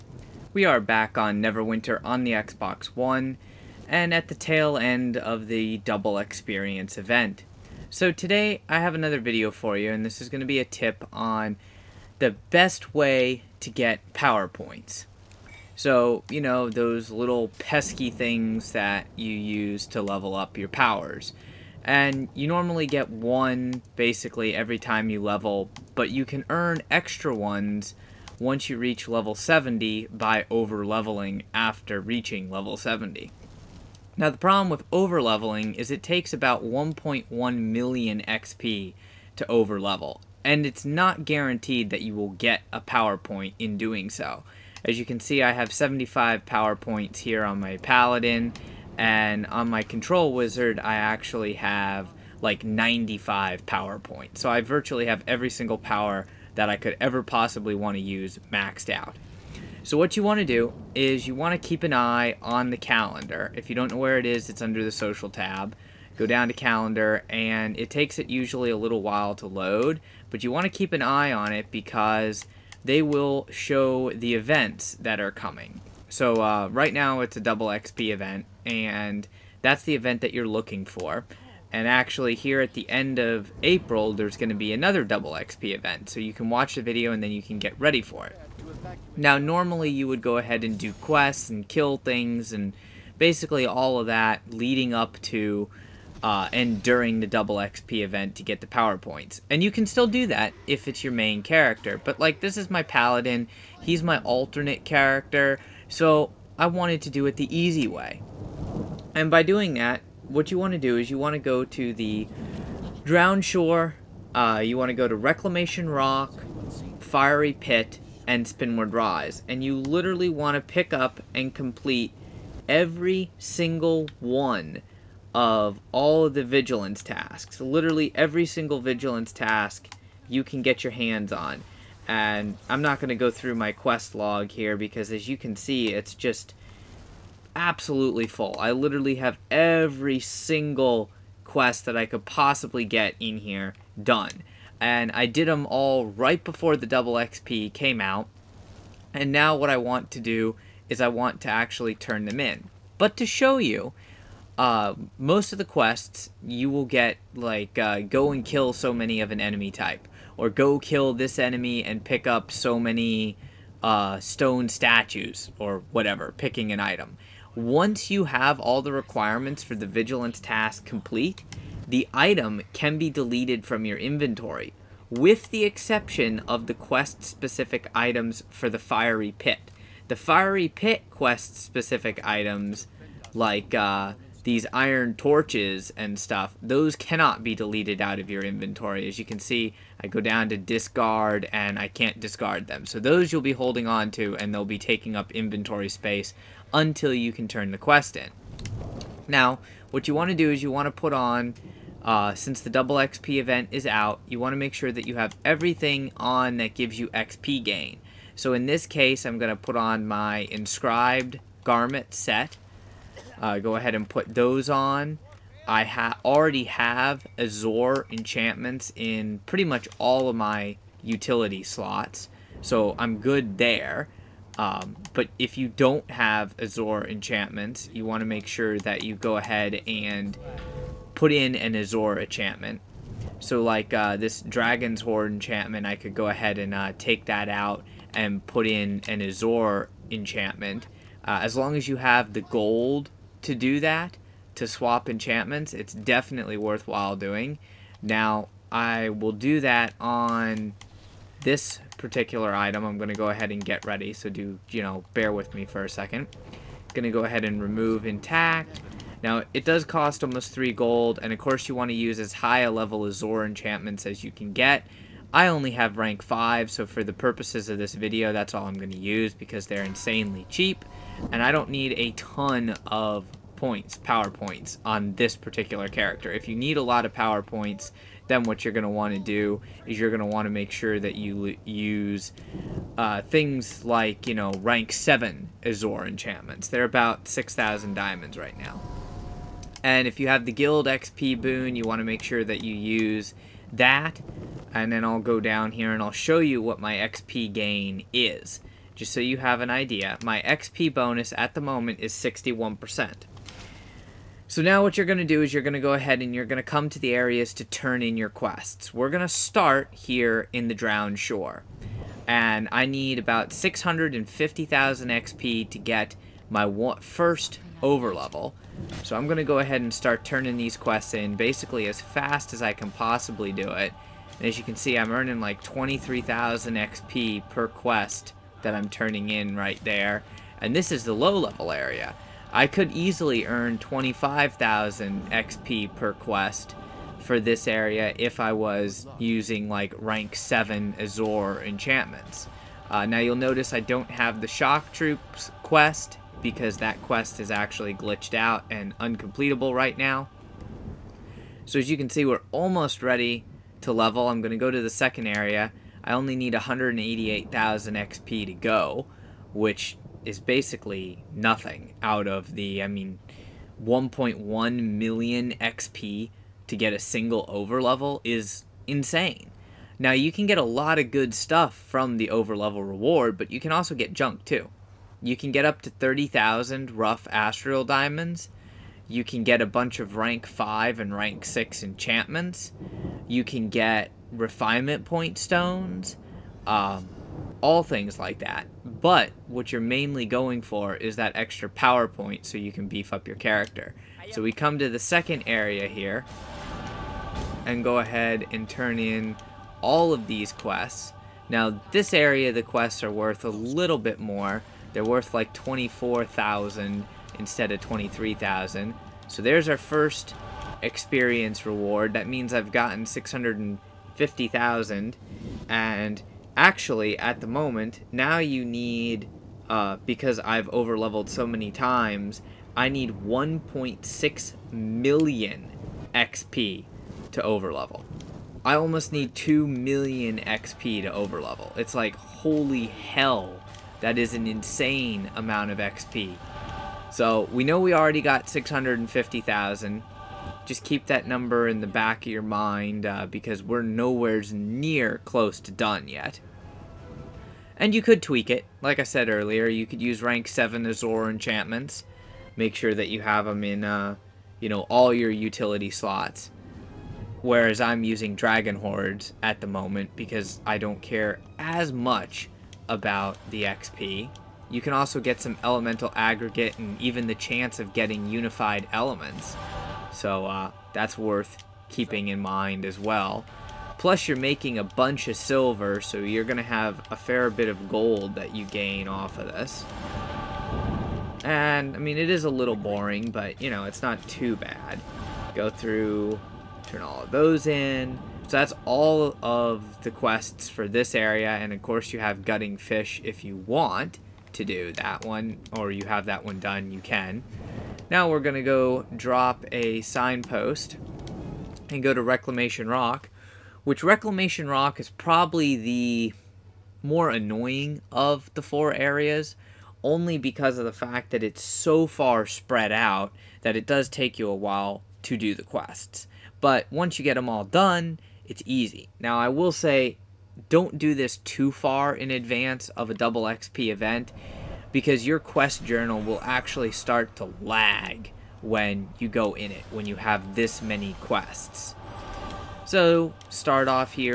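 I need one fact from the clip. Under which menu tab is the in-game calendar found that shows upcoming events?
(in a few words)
social tab.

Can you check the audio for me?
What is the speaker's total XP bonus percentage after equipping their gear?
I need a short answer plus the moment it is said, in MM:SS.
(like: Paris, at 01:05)
61%, at 05:02.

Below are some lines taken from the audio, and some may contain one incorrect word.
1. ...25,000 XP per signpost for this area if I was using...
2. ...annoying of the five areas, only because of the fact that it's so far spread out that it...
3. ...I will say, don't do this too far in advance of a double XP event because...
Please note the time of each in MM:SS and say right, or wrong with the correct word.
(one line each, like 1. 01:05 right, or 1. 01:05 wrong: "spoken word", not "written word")
1. 05:33 wrong: "quest", not "signpost"
2. 08:27 wrong: "four", not "five"
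3. 08:39 right.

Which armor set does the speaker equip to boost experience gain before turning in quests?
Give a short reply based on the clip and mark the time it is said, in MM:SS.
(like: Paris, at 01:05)
inscribed garment set, at 03:30.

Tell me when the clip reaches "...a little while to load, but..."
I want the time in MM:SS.
01:08.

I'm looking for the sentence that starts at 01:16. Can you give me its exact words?
So uh, right now it's a double XP event and that's the event that you're looking for.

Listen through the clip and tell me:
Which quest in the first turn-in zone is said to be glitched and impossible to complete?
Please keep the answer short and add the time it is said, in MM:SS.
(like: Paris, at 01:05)
Shock Troops, at 05:44.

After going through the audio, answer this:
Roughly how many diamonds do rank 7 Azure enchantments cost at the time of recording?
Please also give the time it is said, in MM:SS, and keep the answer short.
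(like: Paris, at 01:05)
6,000, at 04:47.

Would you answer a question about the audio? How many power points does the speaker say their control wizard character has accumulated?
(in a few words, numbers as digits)
95.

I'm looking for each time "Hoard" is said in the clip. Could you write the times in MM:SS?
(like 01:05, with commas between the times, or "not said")
03:55, 07:38.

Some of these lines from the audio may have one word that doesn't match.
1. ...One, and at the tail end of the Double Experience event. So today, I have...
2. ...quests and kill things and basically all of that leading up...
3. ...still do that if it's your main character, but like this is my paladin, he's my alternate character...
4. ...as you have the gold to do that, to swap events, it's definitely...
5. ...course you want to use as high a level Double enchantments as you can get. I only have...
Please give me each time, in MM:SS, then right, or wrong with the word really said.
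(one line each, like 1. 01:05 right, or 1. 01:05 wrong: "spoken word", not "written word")
1. 00:02 right
2. 01:30 right
3. 01:39 right
4. 04:01 wrong: "enchantments", not "events"
5. 04:21 wrong: "Azure", not "Double".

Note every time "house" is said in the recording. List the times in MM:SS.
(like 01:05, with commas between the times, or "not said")
not said.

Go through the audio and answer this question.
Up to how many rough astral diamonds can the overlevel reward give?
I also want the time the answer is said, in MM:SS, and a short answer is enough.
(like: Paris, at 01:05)
30,000, at 06:15.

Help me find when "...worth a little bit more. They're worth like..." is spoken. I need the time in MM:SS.
06:43.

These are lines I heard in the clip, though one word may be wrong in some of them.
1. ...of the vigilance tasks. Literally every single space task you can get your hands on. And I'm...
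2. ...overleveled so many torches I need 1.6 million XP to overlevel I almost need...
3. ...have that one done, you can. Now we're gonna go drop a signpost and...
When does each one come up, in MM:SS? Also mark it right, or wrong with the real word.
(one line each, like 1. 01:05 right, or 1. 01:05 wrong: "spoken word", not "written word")
1. 02:06 wrong: "vigilance", not "space"
2. 07:00 wrong: "times", not "torches"
3. 08:16 right.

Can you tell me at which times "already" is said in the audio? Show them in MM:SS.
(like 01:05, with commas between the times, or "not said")
03:36, 07:17.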